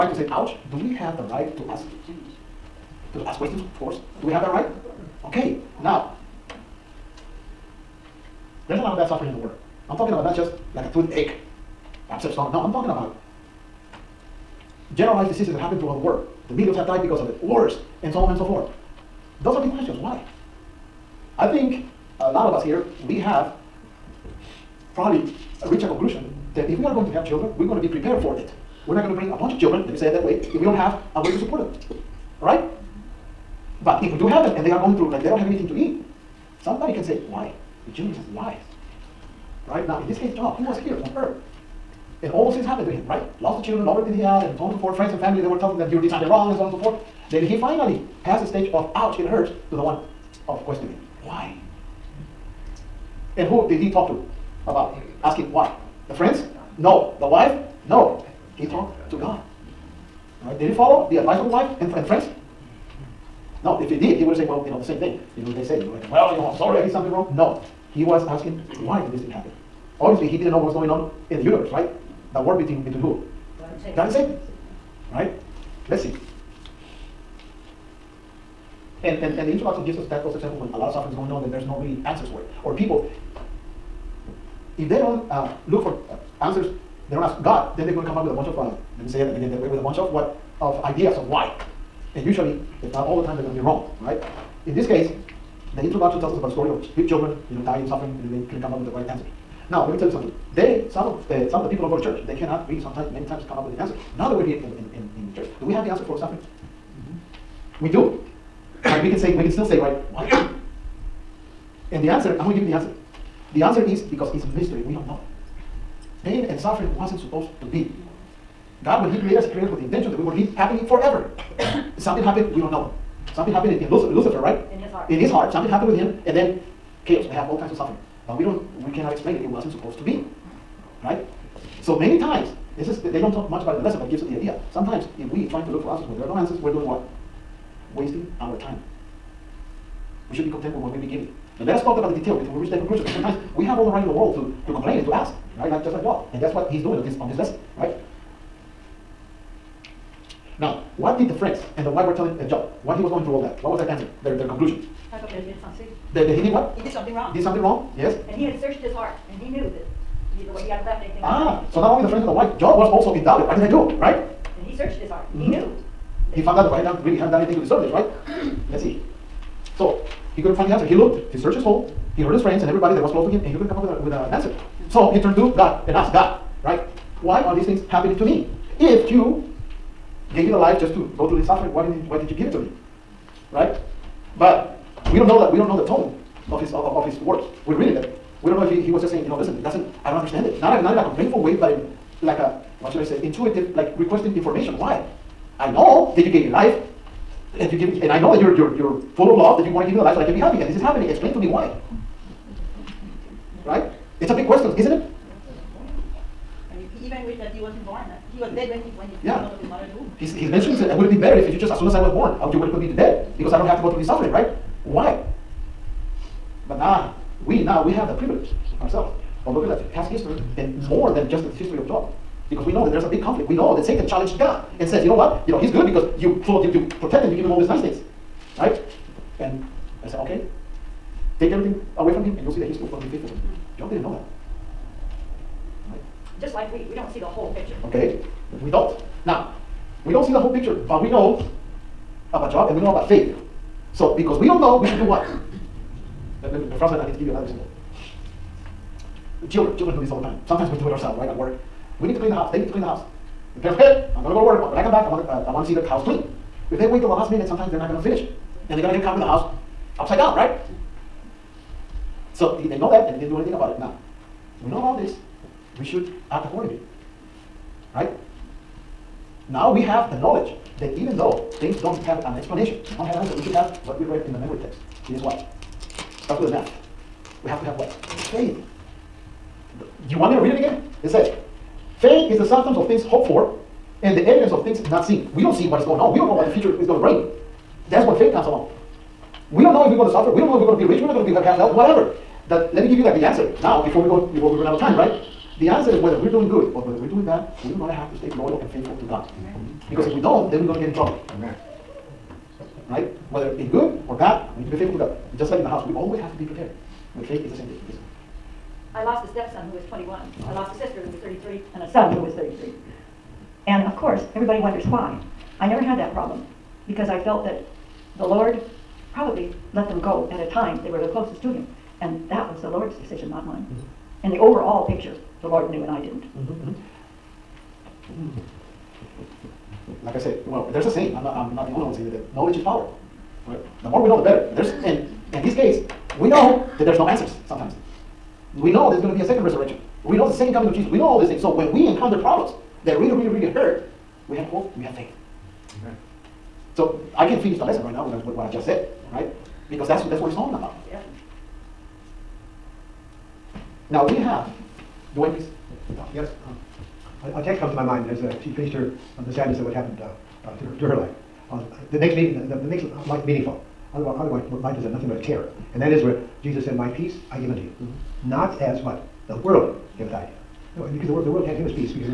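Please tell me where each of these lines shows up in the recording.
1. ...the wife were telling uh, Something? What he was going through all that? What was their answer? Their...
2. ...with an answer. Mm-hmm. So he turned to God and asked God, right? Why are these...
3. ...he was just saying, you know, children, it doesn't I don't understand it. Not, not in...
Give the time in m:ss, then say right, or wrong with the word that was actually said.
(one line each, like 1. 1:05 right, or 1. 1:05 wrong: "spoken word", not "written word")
1. 2:31 wrong: "Job", not "Something"
2. 2:54 right
3. 3:08 wrong: "listen", not "children".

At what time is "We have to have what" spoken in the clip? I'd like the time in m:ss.
4:37.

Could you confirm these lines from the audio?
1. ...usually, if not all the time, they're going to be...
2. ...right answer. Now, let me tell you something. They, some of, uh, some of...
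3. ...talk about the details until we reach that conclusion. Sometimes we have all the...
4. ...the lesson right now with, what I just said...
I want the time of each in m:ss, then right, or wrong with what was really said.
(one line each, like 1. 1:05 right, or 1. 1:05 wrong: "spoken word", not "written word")
1. 1:32 right
2. 1:38 right
3. 2:21 right
4. 5:47 right.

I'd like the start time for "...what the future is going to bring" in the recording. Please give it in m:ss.
4:46.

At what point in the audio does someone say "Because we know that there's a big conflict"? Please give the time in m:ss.
3:42.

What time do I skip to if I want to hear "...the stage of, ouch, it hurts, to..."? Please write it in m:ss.
0:48.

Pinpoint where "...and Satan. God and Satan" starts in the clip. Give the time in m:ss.
1:13.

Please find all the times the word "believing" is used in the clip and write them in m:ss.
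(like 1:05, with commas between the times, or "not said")
not said.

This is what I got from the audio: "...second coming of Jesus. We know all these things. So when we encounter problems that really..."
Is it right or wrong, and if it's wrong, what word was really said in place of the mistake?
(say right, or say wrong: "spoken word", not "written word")
right.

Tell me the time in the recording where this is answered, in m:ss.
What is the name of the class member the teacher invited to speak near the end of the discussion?
5:55.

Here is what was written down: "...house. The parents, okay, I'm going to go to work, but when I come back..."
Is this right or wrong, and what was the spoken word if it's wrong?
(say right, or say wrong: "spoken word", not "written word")
right.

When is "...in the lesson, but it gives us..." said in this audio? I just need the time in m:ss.
2:13.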